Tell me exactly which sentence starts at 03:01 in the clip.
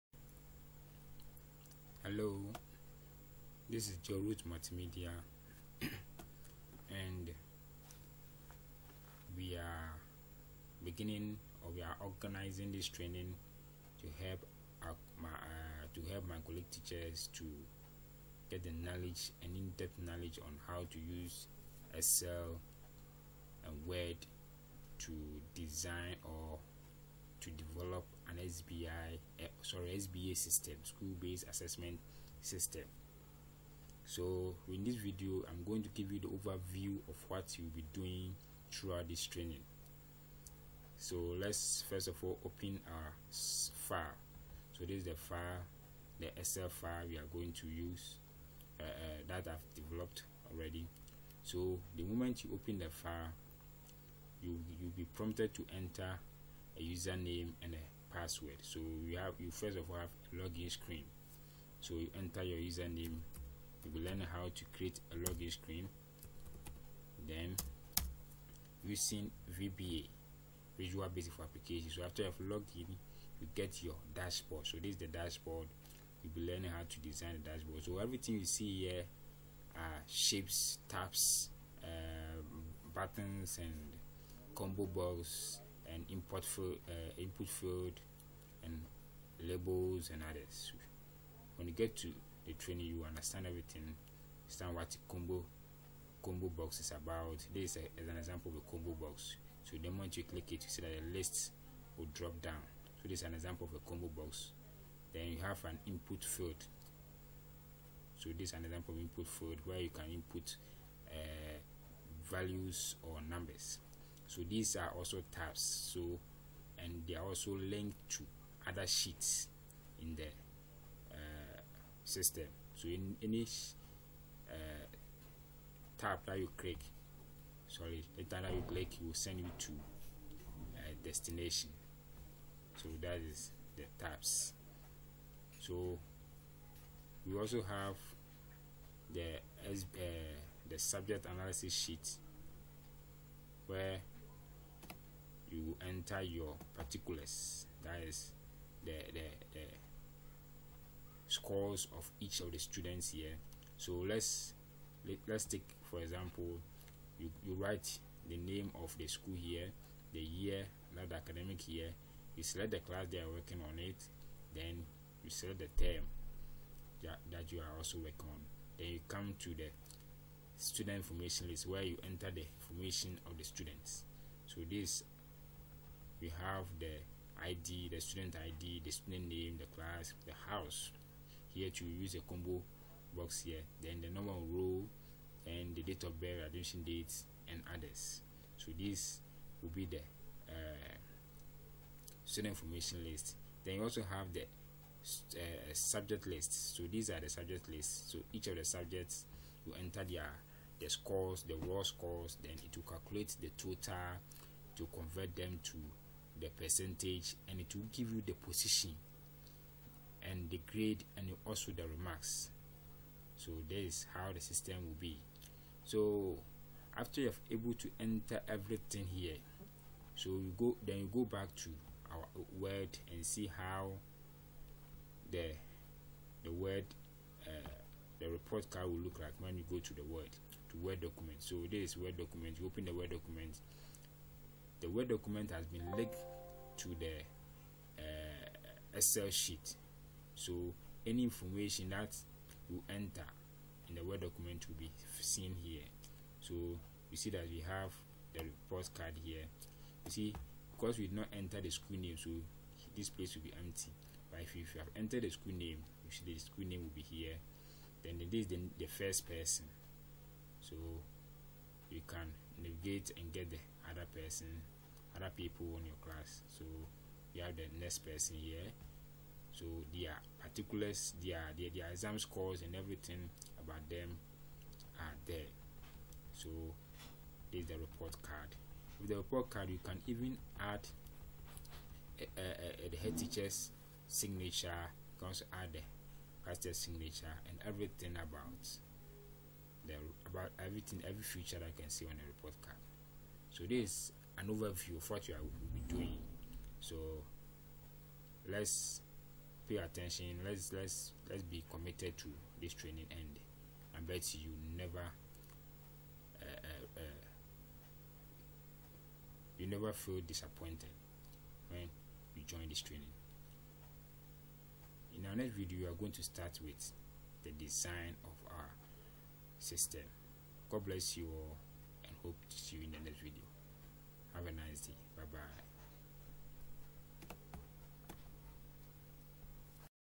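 Here to use a combo box here, then the normal row and the date of birth, admission dates, and others.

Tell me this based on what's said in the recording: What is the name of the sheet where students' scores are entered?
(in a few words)
subject analysis sheet.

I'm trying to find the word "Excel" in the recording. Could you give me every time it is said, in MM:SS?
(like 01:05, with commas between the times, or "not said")
00:21, 00:46, 03:58.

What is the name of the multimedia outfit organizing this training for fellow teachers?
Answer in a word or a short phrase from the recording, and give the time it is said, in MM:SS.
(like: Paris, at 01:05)
Jorut Multimedia, at 00:04.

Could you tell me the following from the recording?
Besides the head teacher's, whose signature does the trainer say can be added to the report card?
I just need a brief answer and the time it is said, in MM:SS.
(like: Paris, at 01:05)
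The pastor's, at 04:46.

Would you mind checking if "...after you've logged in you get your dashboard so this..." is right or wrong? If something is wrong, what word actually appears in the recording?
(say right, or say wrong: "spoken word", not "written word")
right.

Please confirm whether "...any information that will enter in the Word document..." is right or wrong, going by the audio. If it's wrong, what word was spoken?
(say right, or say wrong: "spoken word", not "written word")
right.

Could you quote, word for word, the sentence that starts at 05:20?
God bless you all and hope to see you in the next video.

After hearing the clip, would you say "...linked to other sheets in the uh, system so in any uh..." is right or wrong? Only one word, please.
right.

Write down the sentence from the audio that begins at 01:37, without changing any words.
This is, a, is an example of a combo box.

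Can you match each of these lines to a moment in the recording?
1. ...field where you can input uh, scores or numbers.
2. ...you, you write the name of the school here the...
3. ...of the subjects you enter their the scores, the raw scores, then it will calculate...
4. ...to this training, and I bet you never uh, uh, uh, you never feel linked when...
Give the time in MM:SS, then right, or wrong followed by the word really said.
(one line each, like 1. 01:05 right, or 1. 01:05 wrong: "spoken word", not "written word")
1. 01:49 wrong: "values", not "scores"
2. 02:37 right
3. 03:18 right
4. 05:02 wrong: "disappointed", not "linked".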